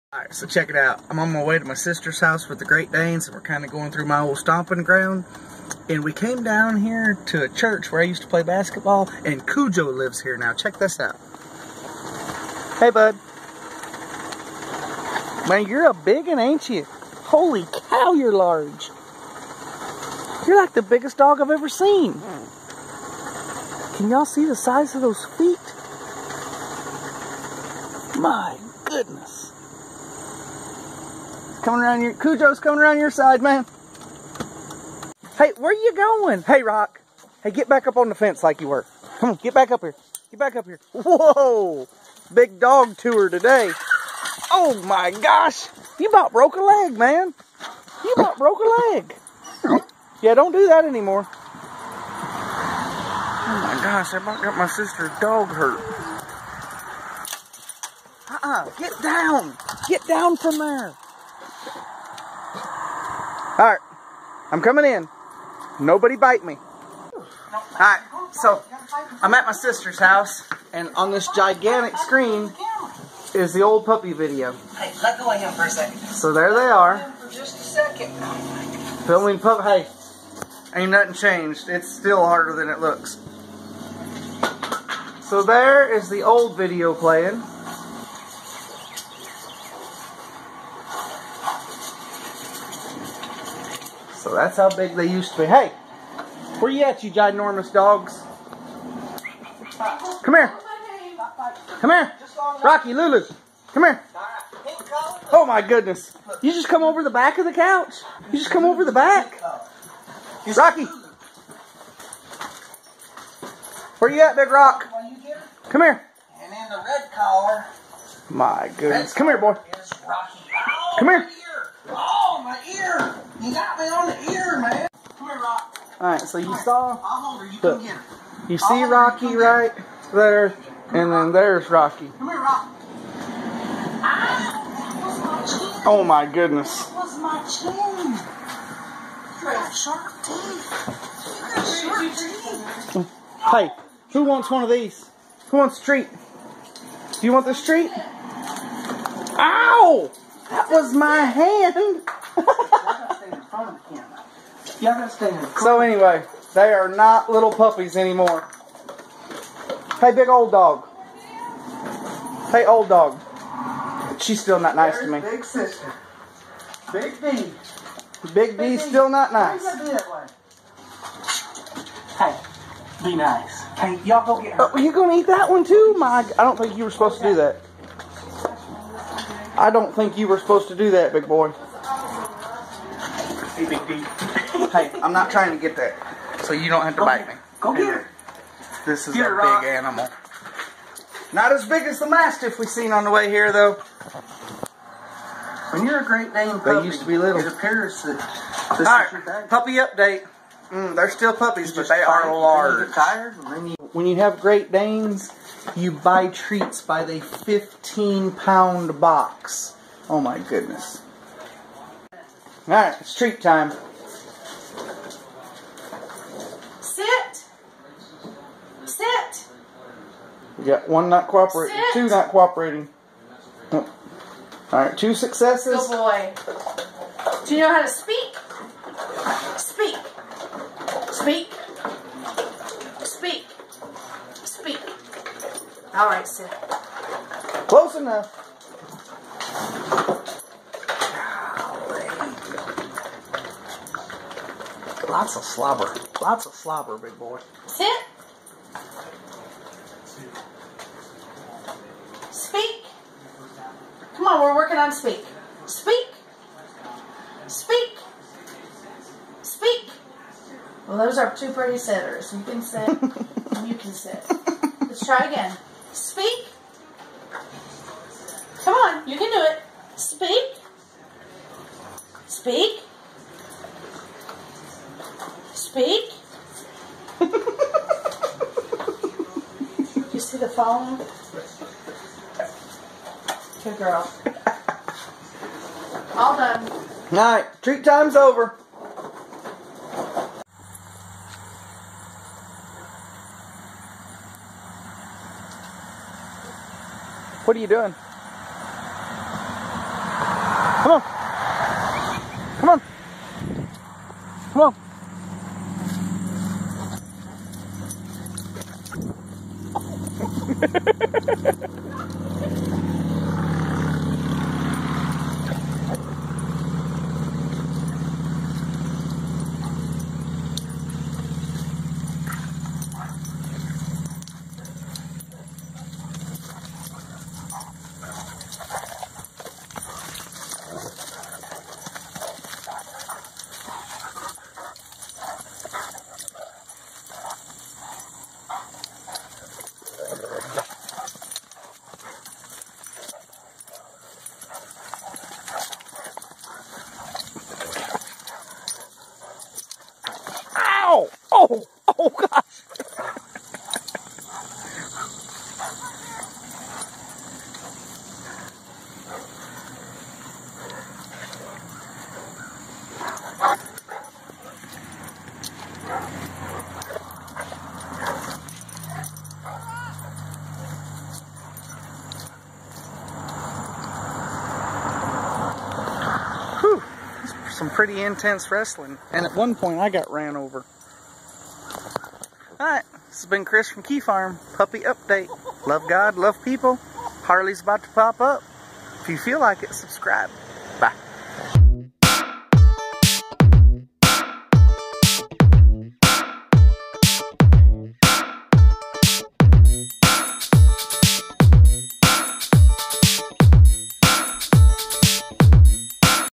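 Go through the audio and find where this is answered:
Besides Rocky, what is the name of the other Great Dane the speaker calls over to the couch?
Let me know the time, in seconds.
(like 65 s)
102 s.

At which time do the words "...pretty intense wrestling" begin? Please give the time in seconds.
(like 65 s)
377 s.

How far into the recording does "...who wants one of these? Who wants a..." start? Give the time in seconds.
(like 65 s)
144 s.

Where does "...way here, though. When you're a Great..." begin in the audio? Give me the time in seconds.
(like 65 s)
193 s.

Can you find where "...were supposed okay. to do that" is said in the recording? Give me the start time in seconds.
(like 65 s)
176 s.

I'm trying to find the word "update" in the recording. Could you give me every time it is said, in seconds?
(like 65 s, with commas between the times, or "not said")
199 s, 384 s.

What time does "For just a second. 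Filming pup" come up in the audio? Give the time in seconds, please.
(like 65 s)
77 s.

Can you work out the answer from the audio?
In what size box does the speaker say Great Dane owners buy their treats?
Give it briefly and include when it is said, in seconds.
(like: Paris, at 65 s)
15-pound box, at 207 s.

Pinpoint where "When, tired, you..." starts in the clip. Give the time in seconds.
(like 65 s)
202 s.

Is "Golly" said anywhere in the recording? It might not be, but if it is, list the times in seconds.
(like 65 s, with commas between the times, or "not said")
241 s.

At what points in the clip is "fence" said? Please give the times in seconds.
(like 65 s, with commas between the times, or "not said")
38 s.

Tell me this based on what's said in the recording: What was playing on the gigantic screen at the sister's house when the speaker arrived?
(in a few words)
The old puppy video.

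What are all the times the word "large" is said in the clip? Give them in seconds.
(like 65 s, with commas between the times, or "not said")
18 s, 202 s.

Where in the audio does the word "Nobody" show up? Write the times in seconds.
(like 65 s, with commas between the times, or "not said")
65 s.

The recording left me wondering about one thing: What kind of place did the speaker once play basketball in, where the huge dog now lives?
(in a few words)
Church.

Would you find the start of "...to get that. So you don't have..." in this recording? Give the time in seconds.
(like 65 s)
185 s.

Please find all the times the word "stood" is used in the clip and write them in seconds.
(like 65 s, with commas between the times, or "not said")
not said.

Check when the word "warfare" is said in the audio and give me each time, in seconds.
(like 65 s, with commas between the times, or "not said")
not said.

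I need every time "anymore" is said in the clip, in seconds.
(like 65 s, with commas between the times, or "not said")
50 s, 157 s.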